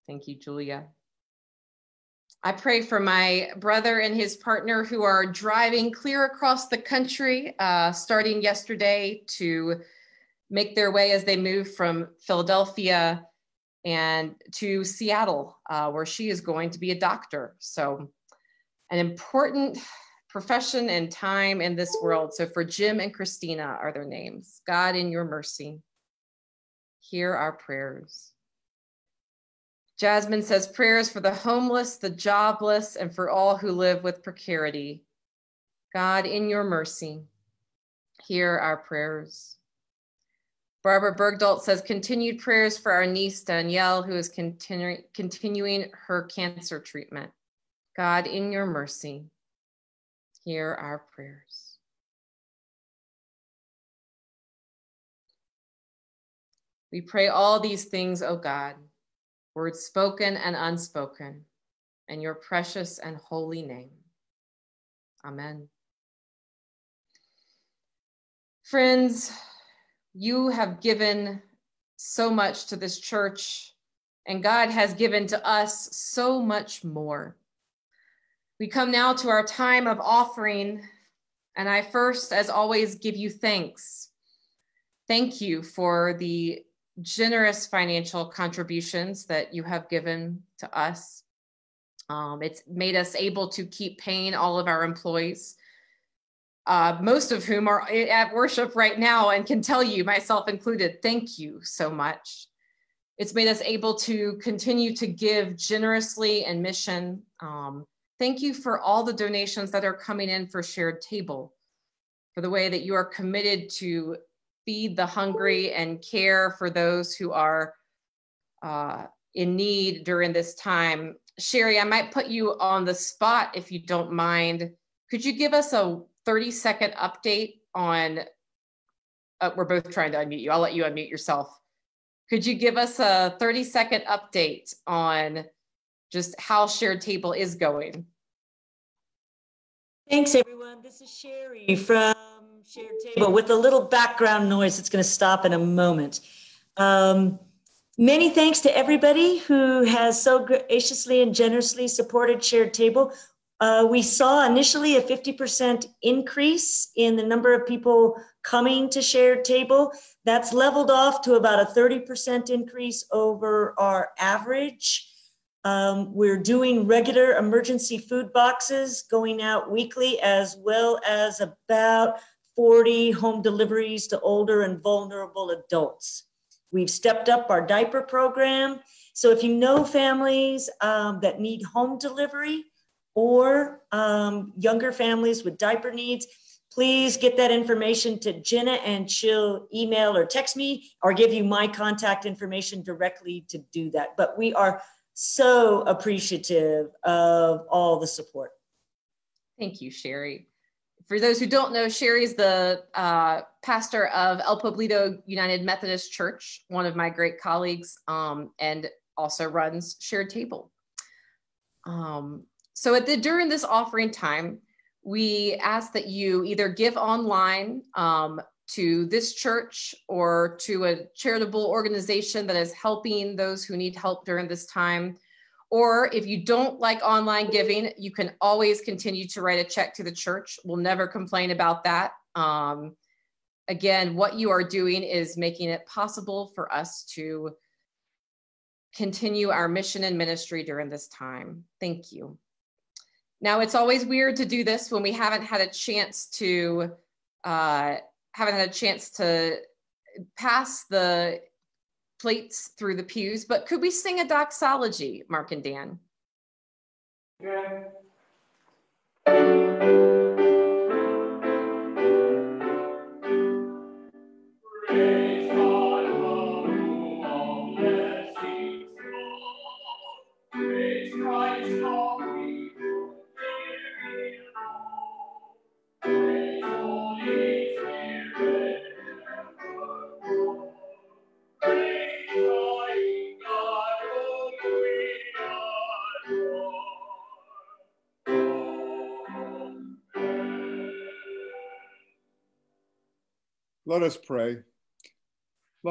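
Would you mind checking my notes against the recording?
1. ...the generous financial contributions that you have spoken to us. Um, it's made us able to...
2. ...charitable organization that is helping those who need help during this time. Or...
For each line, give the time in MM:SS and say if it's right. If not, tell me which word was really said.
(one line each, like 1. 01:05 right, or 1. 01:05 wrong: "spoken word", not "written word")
1. 01:26 wrong: "given", not "spoken"
2. 03:41 right.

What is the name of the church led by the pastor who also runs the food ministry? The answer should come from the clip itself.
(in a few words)
El Pueblito United Methodist Church.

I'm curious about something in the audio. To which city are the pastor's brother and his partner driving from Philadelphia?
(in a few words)
Seattle.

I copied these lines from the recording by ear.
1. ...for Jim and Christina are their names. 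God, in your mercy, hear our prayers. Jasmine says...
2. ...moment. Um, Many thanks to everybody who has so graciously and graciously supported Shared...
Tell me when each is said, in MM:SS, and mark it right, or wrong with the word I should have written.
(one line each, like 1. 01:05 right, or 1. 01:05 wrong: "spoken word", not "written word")
1. 00:22 right
2. 02:25 wrong: "generously", not "graciously".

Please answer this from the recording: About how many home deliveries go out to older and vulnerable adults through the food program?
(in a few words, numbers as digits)
40.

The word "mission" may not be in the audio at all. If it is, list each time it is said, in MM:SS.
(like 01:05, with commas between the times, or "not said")
01:46, 03:59.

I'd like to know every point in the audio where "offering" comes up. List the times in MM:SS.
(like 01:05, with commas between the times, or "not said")
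01:19, 03:33.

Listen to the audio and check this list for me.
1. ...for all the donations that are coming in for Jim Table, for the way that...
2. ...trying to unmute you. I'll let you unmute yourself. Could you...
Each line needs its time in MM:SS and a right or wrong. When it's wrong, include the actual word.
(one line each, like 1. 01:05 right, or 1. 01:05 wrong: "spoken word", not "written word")
1. 01:48 wrong: "Shared", not "Jim"
2. 02:09 right.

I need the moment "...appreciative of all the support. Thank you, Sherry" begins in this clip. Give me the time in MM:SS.
03:15.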